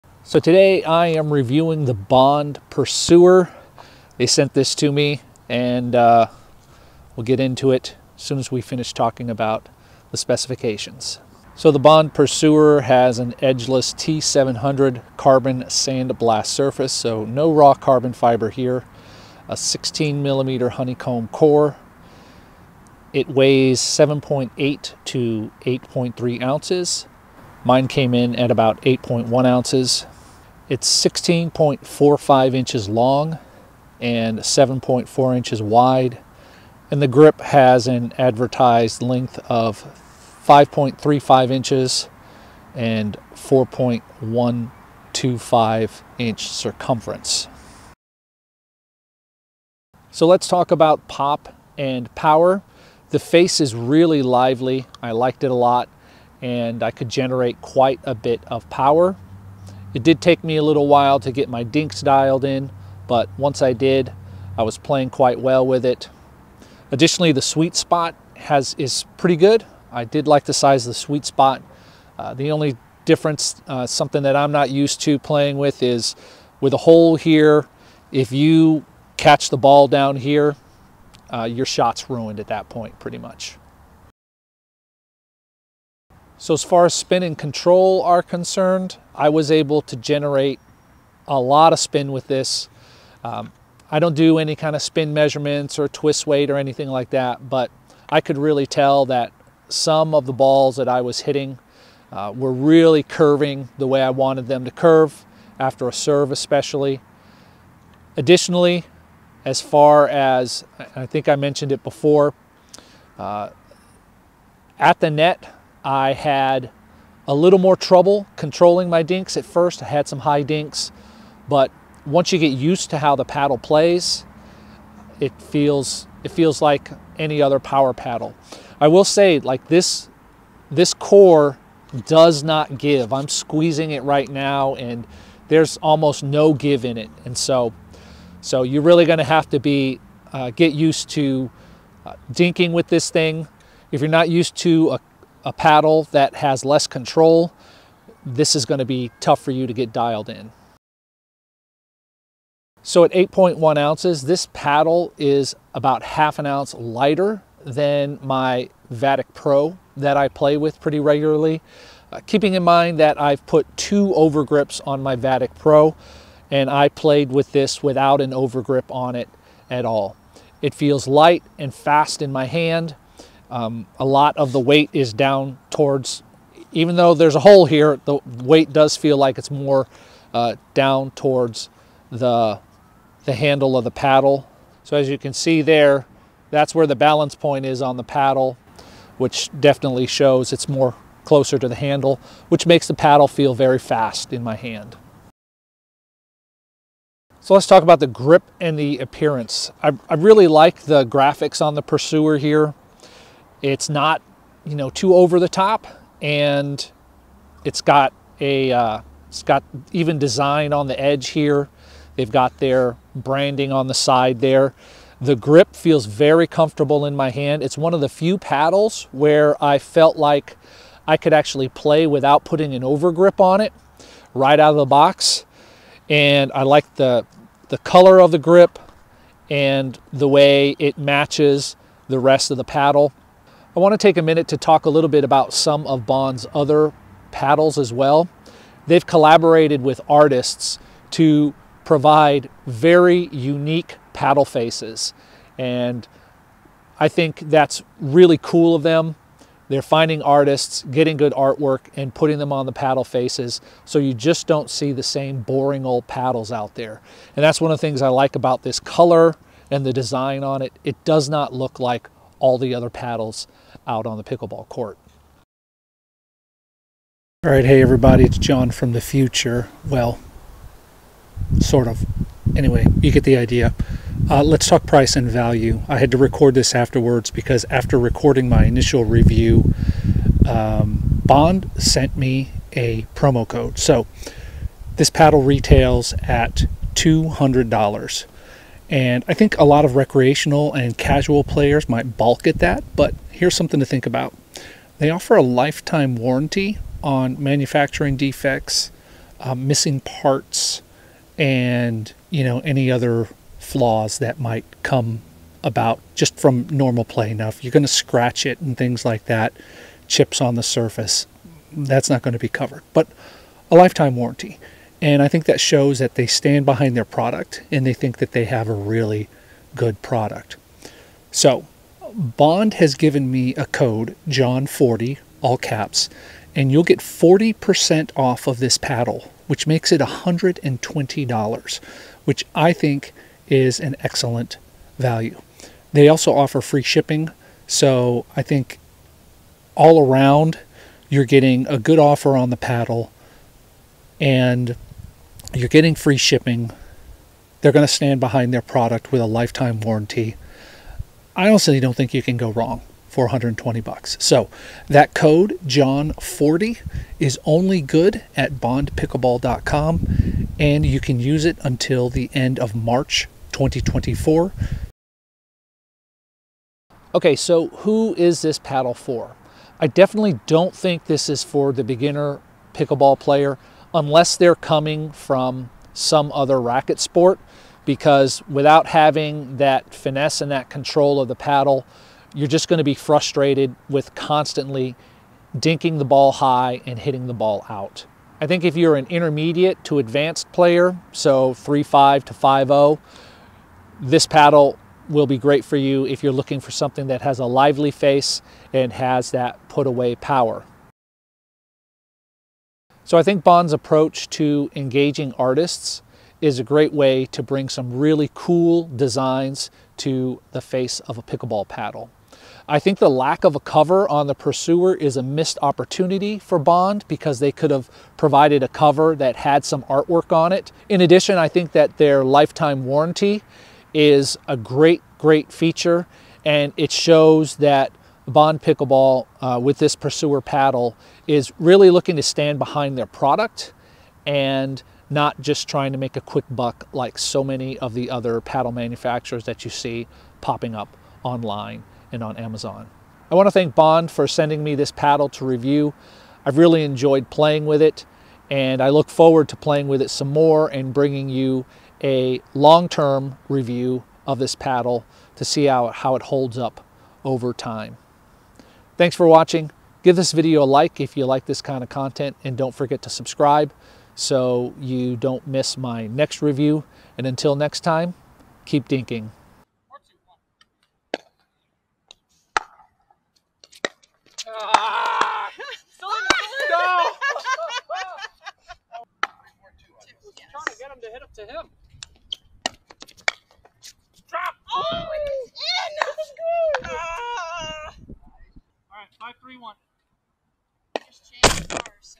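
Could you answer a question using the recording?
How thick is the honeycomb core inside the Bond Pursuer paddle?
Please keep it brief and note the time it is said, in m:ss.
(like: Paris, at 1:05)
16 millimeters, at 0:19.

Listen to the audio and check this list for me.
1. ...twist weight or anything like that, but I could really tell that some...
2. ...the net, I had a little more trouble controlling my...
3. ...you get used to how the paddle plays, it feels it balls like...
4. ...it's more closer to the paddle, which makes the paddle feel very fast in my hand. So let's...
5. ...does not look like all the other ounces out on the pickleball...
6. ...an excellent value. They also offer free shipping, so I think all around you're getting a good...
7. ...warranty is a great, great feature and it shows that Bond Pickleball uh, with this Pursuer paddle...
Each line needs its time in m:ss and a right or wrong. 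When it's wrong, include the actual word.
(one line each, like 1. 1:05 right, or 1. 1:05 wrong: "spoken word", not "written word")
1. 1:35 right
2. 1:55 right
3. 2:02 wrong: "feels", not "balls"
4. 3:10 wrong: "handle", not "paddle"
5. 4:21 wrong: "paddles", not "ounces"
6. 5:33 right
7. 7:02 right.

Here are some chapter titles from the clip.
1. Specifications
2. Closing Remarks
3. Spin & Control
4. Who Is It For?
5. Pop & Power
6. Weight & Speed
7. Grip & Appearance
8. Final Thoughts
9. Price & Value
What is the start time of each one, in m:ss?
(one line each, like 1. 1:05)
1. 0:10
2. 7:22
3. 1:24
4. 6:05
5. 0:48
6. 2:31
7. 3:16
8. 6:42
9. 4:25.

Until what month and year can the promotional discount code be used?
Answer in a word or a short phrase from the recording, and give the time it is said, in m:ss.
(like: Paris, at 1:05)
March 2024, at 6:02.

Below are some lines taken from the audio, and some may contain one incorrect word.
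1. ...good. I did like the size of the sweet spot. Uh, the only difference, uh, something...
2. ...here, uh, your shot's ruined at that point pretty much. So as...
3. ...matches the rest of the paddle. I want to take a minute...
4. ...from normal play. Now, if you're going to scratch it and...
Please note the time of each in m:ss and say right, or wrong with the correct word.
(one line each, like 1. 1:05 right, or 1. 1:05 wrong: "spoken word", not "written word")
1. 1:09 right
2. 1:20 right
3. 3:50 right
4. 5:06 right.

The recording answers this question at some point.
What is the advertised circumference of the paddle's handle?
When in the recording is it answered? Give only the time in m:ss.
0:43.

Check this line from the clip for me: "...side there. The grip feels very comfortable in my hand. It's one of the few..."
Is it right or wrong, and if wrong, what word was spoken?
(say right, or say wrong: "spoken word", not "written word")
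right.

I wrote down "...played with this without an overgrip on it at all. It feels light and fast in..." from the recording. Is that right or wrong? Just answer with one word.
right.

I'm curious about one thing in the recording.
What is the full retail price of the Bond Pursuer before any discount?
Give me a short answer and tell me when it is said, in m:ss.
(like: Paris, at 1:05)
$200, at 4:46.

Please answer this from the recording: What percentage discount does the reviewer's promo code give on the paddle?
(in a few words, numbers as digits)
40%.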